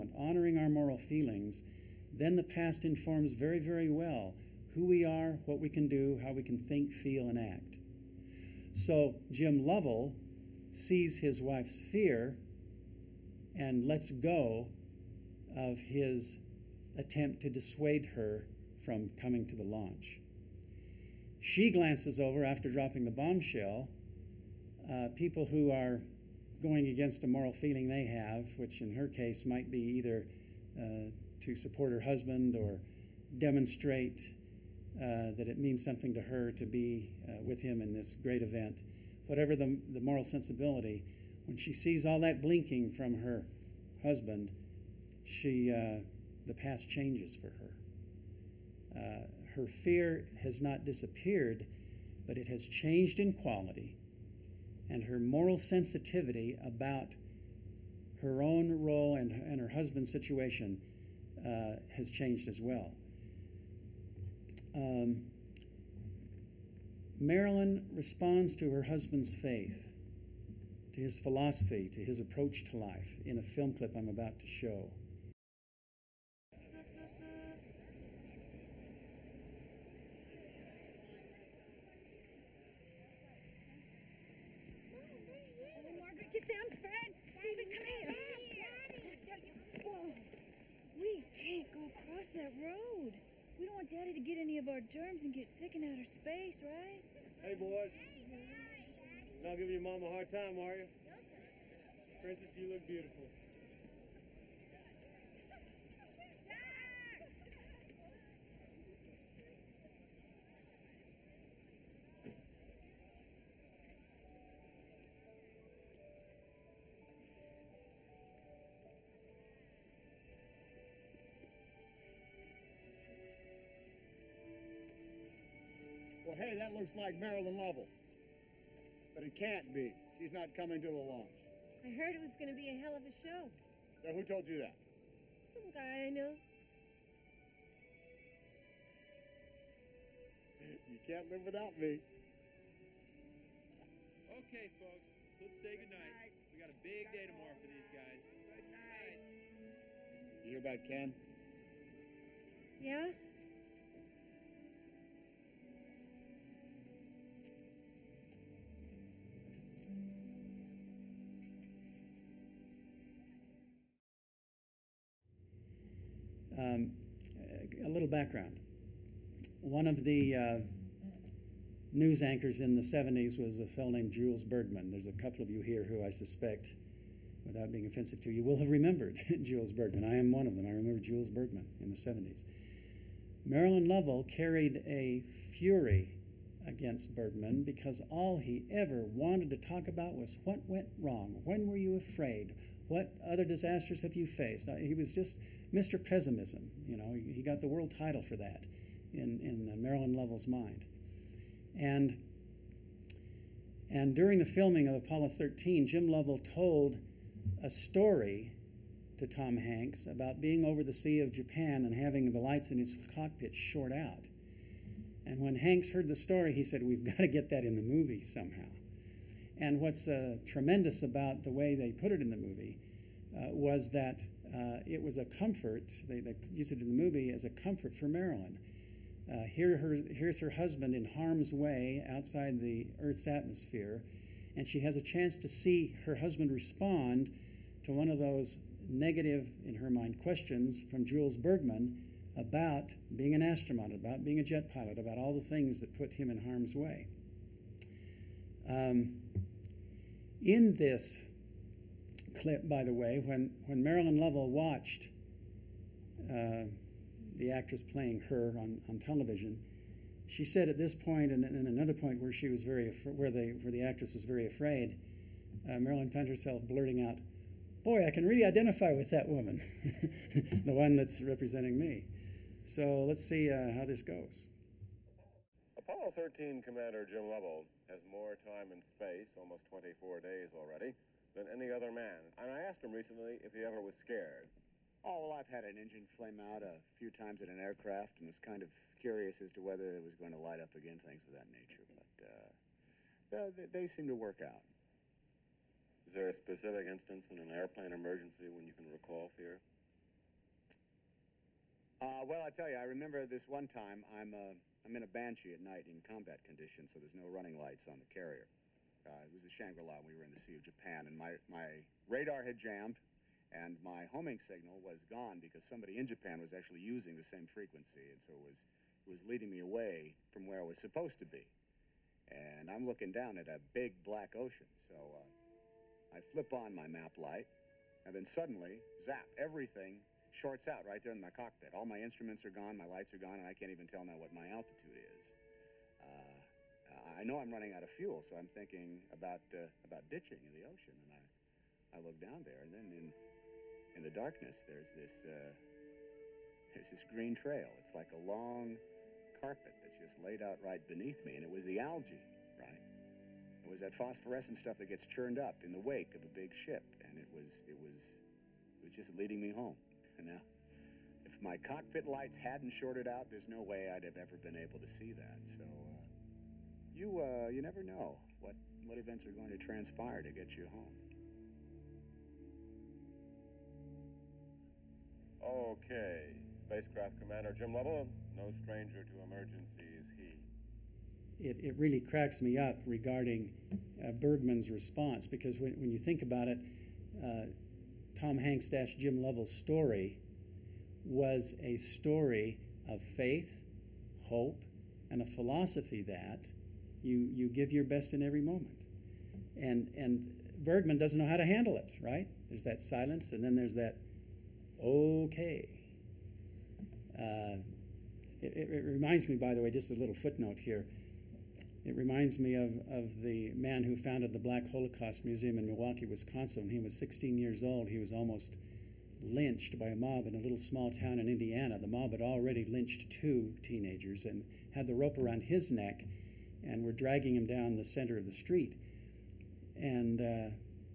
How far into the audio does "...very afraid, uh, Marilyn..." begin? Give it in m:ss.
4:24.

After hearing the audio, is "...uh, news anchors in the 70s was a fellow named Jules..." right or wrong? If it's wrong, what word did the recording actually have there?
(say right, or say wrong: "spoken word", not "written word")
right.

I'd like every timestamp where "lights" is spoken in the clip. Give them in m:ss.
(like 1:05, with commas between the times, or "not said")
3:32, 4:50, 5:07, 5:27, 5:32, 6:02.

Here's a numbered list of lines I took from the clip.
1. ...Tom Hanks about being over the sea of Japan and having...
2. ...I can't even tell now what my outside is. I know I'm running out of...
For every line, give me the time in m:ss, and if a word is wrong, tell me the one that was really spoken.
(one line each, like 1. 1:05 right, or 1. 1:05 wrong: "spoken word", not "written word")
1. 3:29 right
2. 5:33 wrong: "altitude", not "outside".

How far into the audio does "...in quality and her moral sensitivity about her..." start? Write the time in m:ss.
0:53.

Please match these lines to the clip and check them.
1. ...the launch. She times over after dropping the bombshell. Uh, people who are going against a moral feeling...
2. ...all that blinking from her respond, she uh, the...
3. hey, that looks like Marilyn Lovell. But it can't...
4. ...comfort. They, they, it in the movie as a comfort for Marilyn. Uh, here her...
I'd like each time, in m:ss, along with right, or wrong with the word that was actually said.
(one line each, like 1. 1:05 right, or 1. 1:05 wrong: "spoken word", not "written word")
1. 0:19 wrong: "glances", not "times"
2. 0:42 wrong: "husband", not "respond"
3. 2:06 right
4. 3:45 right.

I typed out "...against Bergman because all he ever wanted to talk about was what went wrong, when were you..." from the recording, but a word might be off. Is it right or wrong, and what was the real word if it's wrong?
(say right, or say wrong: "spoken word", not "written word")
right.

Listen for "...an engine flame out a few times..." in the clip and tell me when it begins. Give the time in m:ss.
4:45.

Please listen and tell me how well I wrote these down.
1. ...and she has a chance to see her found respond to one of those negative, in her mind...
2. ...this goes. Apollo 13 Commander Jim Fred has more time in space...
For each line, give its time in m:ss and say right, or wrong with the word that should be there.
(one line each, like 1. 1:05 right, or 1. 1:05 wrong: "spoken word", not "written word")
1. 3:54 wrong: "husband", not "found"
2. 4:33 wrong: "Lovell", not "Fred".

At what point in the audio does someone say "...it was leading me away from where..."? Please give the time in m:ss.
5:19.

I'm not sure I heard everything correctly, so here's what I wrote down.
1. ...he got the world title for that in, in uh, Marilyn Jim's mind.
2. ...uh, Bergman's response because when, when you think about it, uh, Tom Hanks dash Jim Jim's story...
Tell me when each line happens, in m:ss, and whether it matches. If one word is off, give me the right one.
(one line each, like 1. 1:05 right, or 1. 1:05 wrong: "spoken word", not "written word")
1. 3:17 wrong: "Lovell", not "Jim"
2. 6:24 wrong: "Lovell", not "Jim".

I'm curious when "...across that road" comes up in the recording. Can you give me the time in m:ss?
1:31.